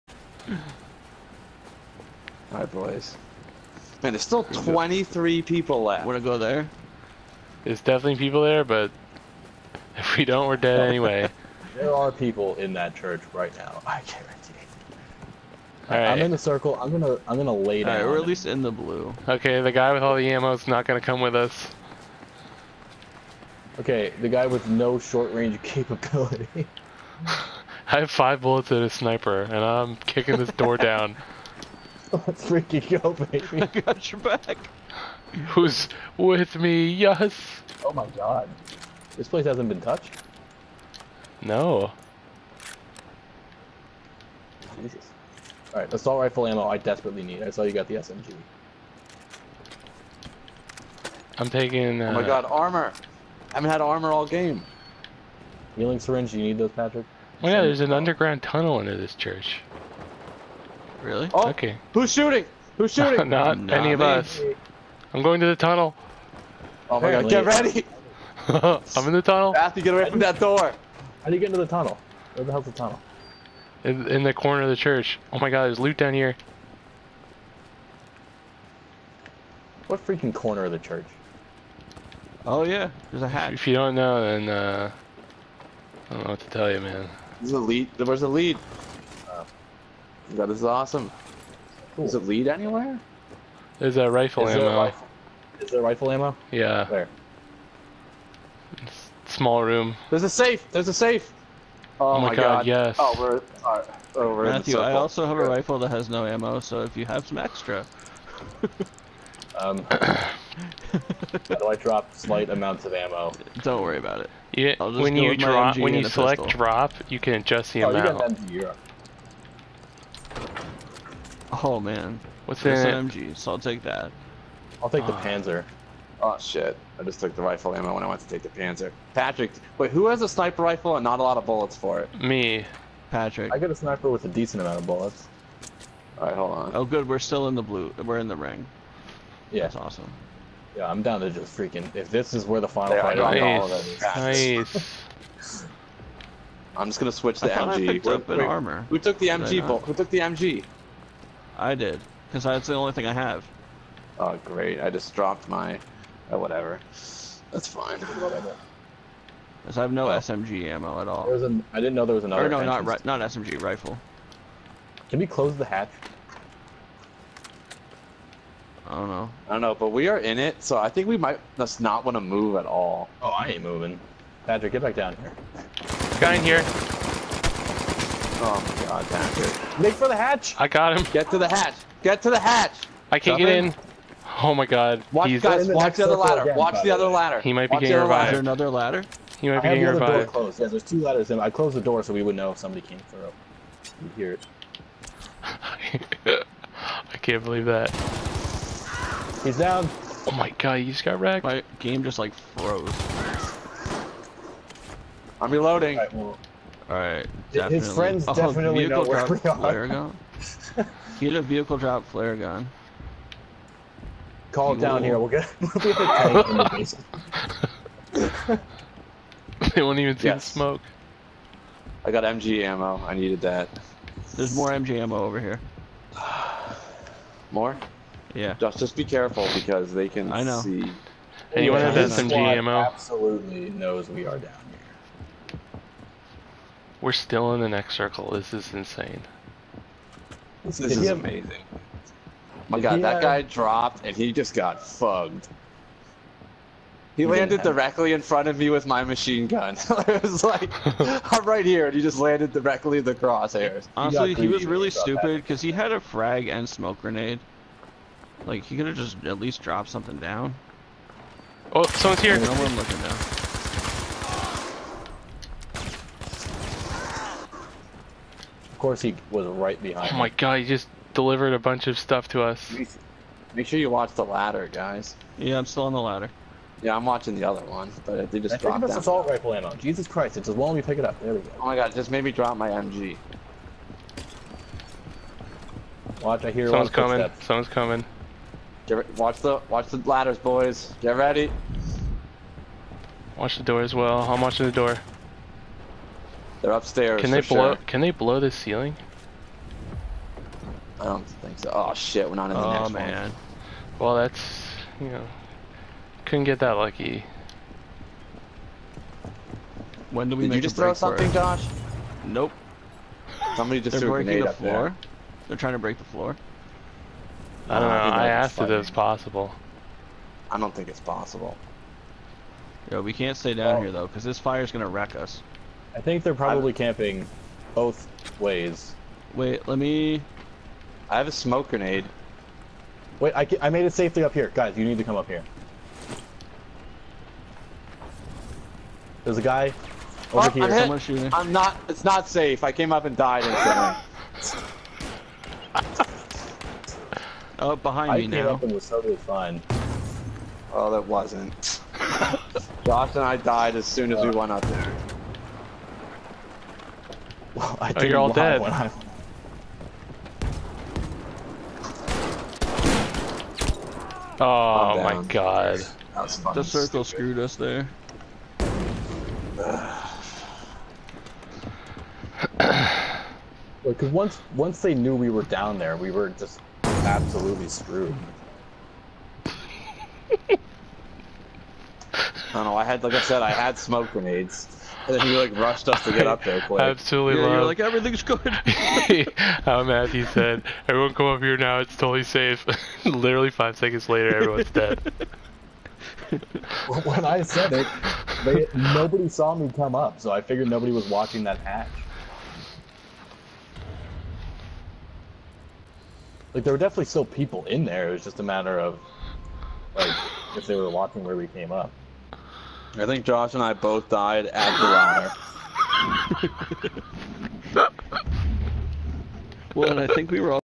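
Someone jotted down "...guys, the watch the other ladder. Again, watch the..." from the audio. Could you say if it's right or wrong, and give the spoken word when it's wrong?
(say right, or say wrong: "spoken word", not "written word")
right.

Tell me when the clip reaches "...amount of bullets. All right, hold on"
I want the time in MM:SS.
02:14.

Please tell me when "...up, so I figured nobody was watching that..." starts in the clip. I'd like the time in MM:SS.
06:39.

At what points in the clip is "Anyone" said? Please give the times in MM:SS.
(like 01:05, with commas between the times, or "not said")
03:51.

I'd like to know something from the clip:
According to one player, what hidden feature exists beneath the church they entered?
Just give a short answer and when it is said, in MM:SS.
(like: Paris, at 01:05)
Underground tunnel, at 00:57.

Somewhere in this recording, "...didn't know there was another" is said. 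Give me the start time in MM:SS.
02:41.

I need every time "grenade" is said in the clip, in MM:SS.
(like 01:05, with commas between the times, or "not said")
04:17, 05:14, 05:31, 06:24.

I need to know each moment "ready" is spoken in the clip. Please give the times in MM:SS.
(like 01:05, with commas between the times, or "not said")
01:07, 04:51.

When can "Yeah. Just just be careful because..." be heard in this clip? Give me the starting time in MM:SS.
03:48.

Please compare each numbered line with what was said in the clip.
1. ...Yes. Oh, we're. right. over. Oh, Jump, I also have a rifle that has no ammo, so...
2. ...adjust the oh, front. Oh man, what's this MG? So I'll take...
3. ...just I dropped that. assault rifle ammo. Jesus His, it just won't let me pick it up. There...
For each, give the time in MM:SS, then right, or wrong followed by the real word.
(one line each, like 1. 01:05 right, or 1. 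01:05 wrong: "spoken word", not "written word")
1. 01:42 wrong: "Matthew", not "Jump"
2. 01:57 wrong: "amount", not "front"
3. 04:38 wrong: "Christ", not "His".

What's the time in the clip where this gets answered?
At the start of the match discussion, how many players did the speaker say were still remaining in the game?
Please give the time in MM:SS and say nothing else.
00:04.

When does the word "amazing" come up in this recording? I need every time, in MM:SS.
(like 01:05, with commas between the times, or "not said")
04:01.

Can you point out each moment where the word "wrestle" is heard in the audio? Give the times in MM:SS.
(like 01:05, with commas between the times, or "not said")
not said.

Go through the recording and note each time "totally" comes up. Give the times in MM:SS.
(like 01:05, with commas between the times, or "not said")
05:48, 06:31.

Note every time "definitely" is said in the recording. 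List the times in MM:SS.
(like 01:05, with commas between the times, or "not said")
00:07, 03:28, 06:46.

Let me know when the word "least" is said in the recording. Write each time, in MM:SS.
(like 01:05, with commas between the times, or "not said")
00:18, 04:19.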